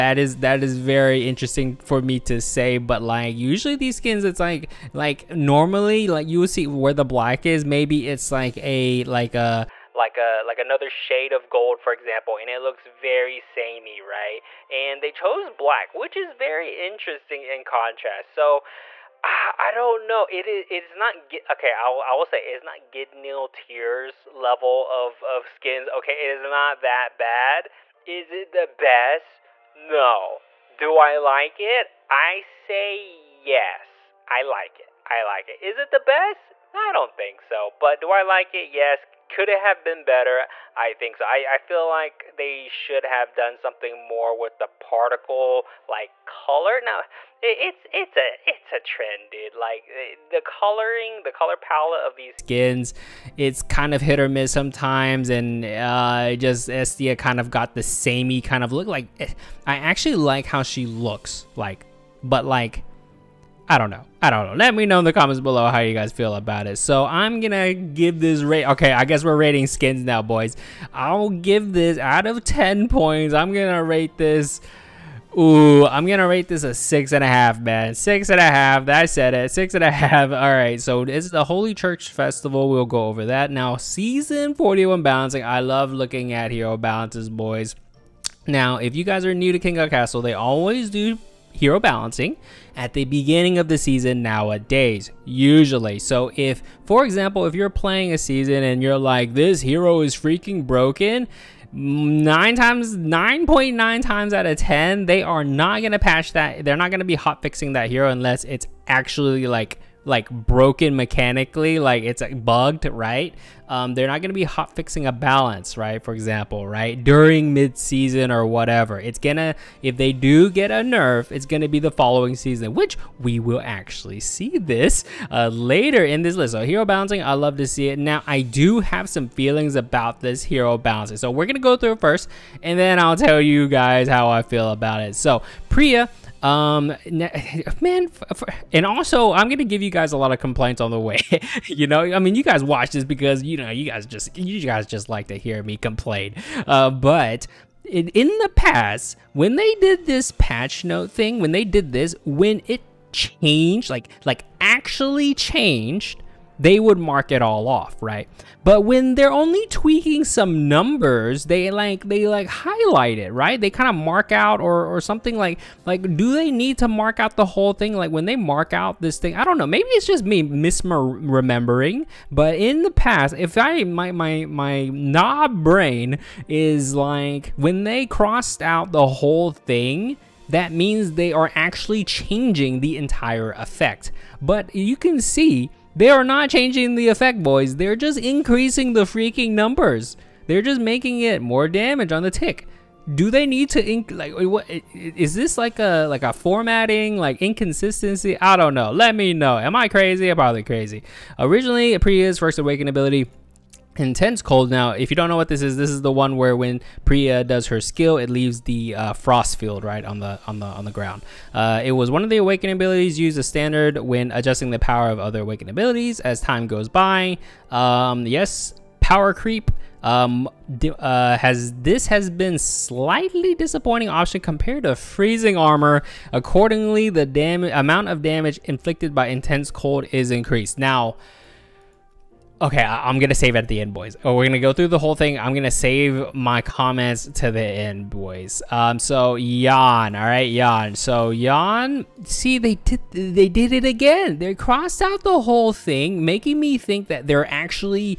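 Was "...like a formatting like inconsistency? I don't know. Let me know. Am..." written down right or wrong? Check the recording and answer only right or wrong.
right.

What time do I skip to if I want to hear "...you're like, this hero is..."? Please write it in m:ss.
1:38.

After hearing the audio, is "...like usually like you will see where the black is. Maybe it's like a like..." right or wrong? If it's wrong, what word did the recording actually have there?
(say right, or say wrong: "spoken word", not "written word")
wrong: "normally", not "usually".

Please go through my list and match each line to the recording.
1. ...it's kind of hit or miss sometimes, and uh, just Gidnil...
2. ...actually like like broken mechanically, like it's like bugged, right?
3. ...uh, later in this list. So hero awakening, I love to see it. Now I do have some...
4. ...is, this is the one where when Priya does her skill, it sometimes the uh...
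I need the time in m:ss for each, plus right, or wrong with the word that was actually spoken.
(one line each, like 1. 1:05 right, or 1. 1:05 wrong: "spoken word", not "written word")
1. 0:53 wrong: "Esthea", not "Gidnil"
2. 1:48 right
3. 2:05 wrong: "balancing", not "awakening"
4. 3:25 wrong: "leaves", not "sometimes".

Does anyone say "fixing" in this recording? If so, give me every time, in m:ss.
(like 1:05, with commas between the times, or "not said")
1:47, 1:54.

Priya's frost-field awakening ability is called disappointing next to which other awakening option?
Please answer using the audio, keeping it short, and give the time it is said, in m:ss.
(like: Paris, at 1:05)
Freezing armor, at 3:44.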